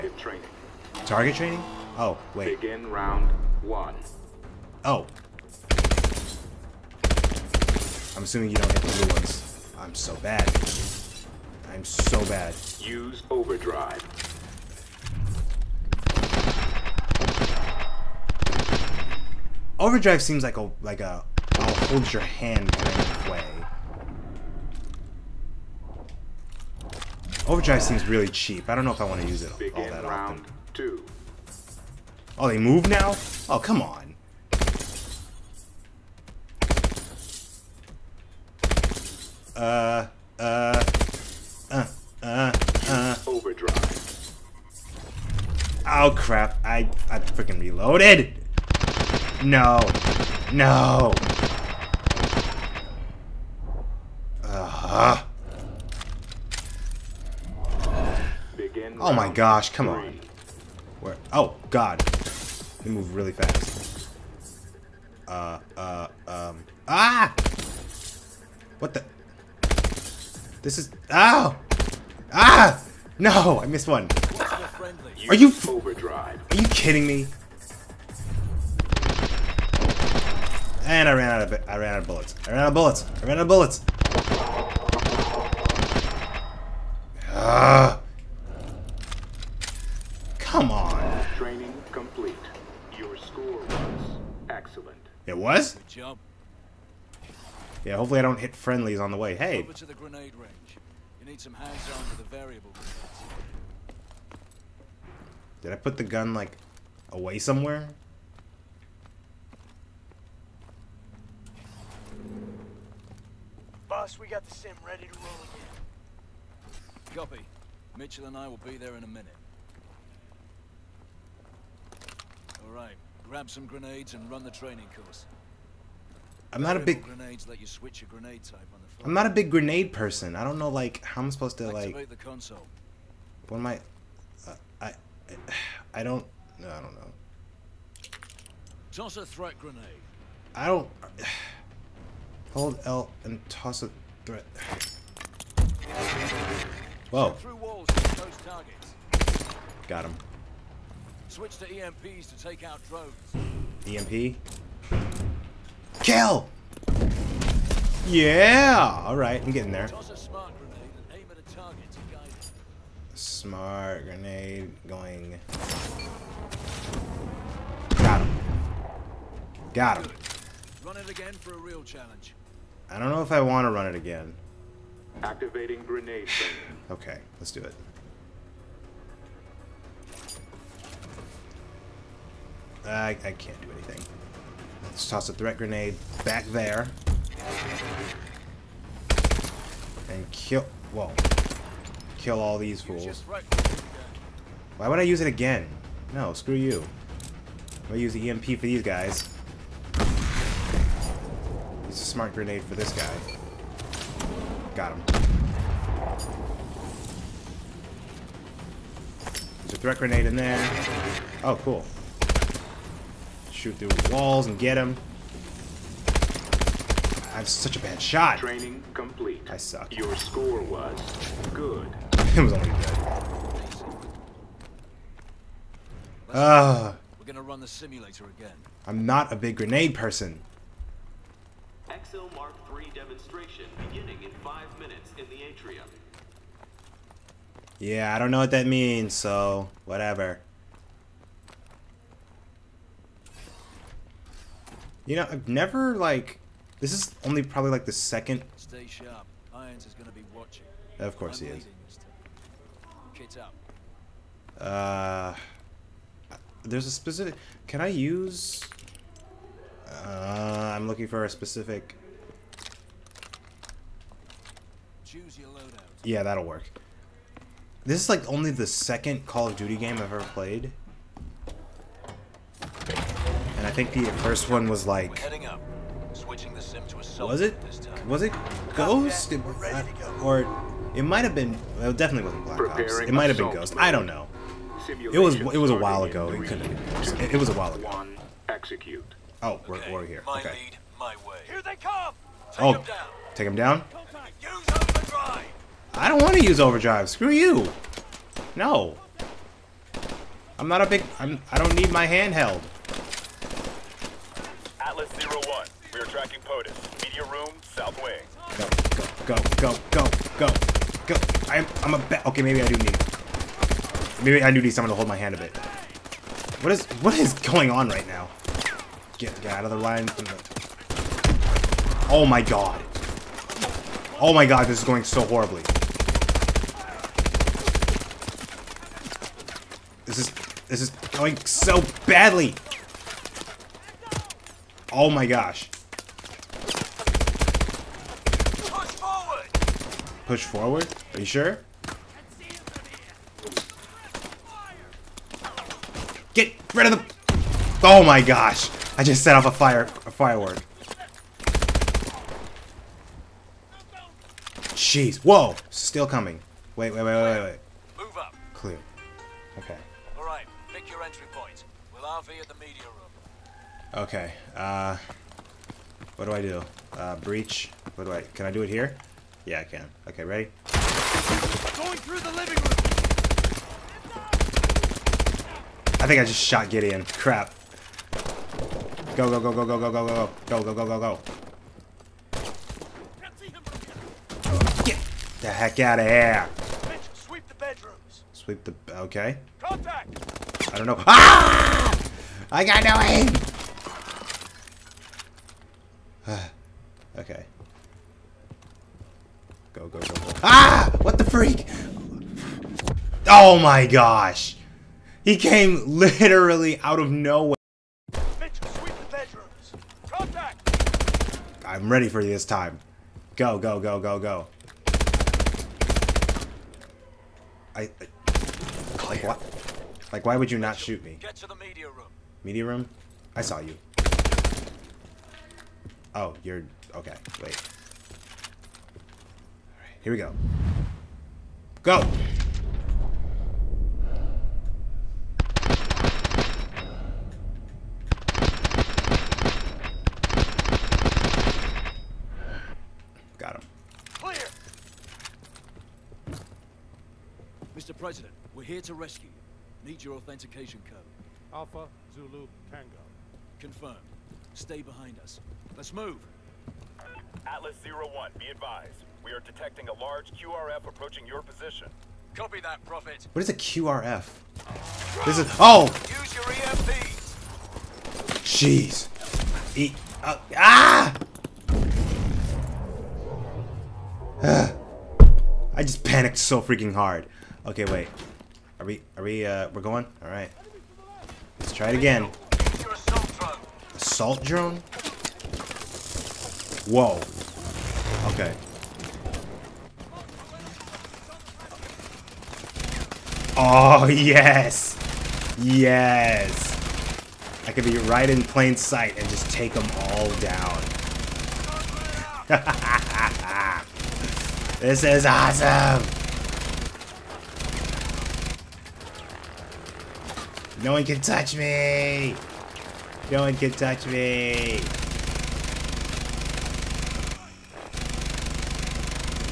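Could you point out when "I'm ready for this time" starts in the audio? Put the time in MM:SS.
06:51.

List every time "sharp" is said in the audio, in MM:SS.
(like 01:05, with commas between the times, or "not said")
04:08.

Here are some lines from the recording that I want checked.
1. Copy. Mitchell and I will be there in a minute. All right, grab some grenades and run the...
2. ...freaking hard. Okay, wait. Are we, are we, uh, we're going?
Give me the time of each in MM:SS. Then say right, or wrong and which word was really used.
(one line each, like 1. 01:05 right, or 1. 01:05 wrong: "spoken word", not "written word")
1. 01:57 right
2. 07:56 right.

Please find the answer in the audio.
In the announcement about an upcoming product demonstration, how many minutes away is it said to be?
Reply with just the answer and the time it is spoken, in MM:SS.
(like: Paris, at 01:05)
5, at 03:54.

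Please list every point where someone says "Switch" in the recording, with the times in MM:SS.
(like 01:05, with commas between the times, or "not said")
02:31.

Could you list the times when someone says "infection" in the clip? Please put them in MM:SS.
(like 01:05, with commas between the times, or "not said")
not said.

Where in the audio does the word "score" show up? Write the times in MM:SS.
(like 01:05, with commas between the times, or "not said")
01:33, 03:40.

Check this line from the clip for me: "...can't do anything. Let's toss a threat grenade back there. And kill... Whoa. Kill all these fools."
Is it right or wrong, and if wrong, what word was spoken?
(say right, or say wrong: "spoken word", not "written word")
right.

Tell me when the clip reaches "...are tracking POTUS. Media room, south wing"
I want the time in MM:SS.
05:05.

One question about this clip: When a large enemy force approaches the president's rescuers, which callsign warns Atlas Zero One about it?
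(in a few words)
Prophet.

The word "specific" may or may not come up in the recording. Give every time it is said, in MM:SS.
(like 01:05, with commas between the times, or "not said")
04:16, 04:21.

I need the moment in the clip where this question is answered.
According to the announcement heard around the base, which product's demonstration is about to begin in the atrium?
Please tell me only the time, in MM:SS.
03:52.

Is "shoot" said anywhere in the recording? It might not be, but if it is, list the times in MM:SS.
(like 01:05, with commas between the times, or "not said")
03:33, 07:00.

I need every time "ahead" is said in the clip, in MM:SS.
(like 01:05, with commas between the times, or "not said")
not said.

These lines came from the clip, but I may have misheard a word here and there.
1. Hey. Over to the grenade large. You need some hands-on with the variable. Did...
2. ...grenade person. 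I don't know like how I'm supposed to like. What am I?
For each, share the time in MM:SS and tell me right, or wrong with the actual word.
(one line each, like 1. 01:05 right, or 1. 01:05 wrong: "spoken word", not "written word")
1. 01:39 wrong: "range", not "large"
2. 02:09 right.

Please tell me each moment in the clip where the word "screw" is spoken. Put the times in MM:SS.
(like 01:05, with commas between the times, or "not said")
03:16, 04:57.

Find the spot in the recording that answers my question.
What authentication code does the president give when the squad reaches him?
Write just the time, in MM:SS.
07:31.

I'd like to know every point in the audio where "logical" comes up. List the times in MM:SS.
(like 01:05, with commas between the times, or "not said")
not said.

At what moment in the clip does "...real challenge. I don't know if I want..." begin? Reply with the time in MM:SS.
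02:51.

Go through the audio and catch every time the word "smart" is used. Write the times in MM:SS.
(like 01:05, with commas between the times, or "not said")
02:43, 03:22.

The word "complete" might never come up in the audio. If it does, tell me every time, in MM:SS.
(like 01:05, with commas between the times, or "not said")
01:31, 03:38.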